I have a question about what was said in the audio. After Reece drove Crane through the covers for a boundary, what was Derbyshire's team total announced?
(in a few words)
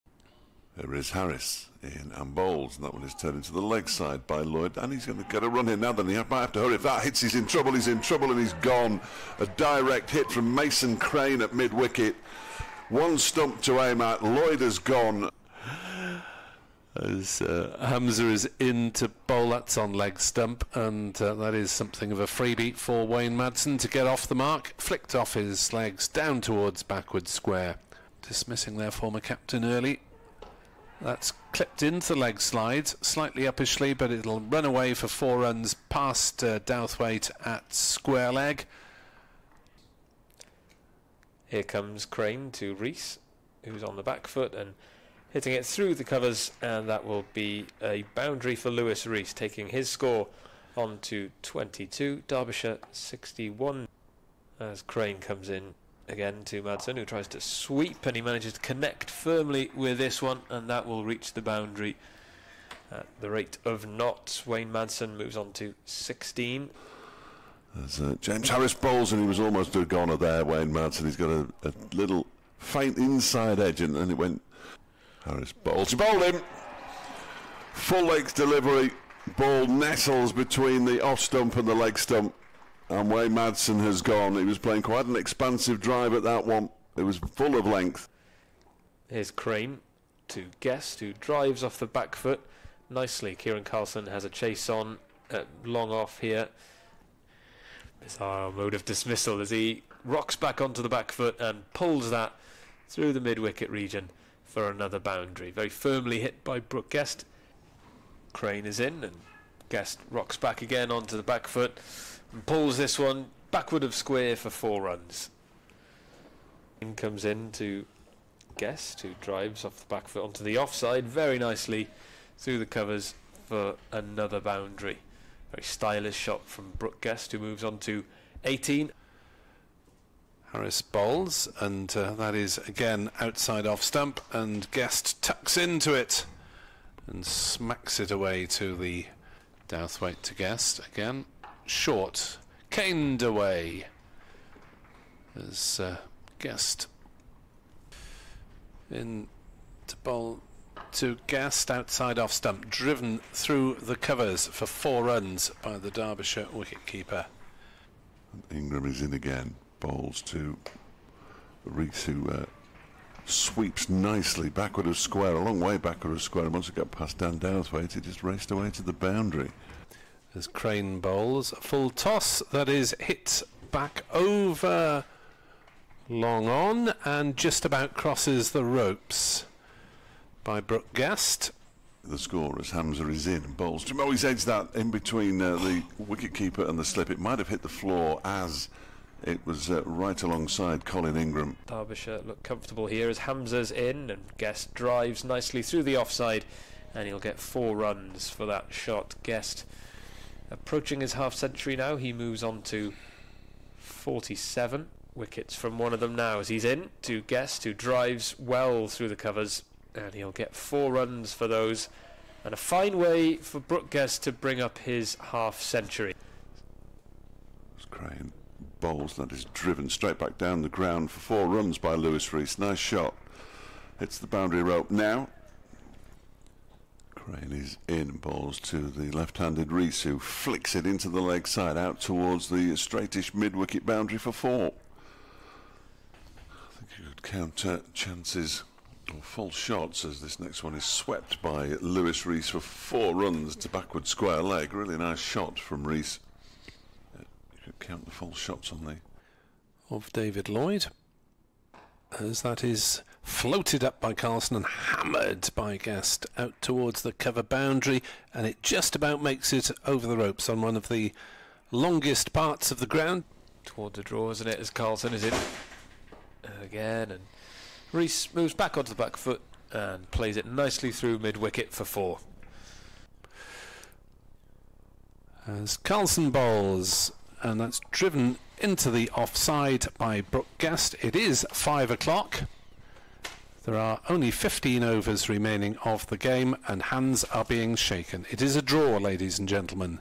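61.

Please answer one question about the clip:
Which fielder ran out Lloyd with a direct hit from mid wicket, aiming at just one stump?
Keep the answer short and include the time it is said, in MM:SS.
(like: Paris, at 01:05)
Mason Crane, at 00:10.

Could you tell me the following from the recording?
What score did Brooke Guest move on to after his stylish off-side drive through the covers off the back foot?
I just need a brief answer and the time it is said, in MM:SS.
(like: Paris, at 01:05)
18, at 02:08.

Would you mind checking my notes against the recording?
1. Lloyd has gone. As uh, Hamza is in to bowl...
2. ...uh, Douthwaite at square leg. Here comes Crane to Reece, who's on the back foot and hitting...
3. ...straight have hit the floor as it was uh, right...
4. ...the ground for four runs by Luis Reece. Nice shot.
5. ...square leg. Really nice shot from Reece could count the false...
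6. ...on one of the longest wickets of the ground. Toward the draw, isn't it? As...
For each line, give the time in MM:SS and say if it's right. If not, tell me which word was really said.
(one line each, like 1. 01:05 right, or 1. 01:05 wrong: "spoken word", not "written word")
1. 00:14 right
2. 00:36 right
3. 03:07 wrong: "might", not "straight"
4. 03:40 right
5. 04:04 right
6. 04:20 wrong: "parts", not "wickets".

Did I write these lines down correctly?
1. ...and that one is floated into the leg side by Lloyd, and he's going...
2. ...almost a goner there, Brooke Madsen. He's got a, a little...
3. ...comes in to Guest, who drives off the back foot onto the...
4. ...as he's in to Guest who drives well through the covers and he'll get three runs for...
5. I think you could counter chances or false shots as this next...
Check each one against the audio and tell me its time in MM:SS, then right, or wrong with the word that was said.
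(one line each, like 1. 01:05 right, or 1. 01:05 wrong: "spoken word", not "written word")
1. 00:02 wrong: "turned", not "floated"
2. 01:09 wrong: "Wayne", not "Brooke"
3. 01:56 right
4. 03:26 wrong: "four", not "three"
5. 03:56 right.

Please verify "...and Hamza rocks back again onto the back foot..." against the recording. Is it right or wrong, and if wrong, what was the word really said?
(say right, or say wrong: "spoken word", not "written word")
wrong: "Guest", not "Hamza".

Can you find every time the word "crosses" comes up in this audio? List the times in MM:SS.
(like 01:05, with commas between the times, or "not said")
02:57.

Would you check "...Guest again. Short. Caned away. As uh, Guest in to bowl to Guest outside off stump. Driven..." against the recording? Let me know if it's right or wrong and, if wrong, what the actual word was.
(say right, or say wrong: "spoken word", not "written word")
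right.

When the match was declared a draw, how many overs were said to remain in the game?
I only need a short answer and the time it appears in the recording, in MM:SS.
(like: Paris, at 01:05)
15, at 04:44.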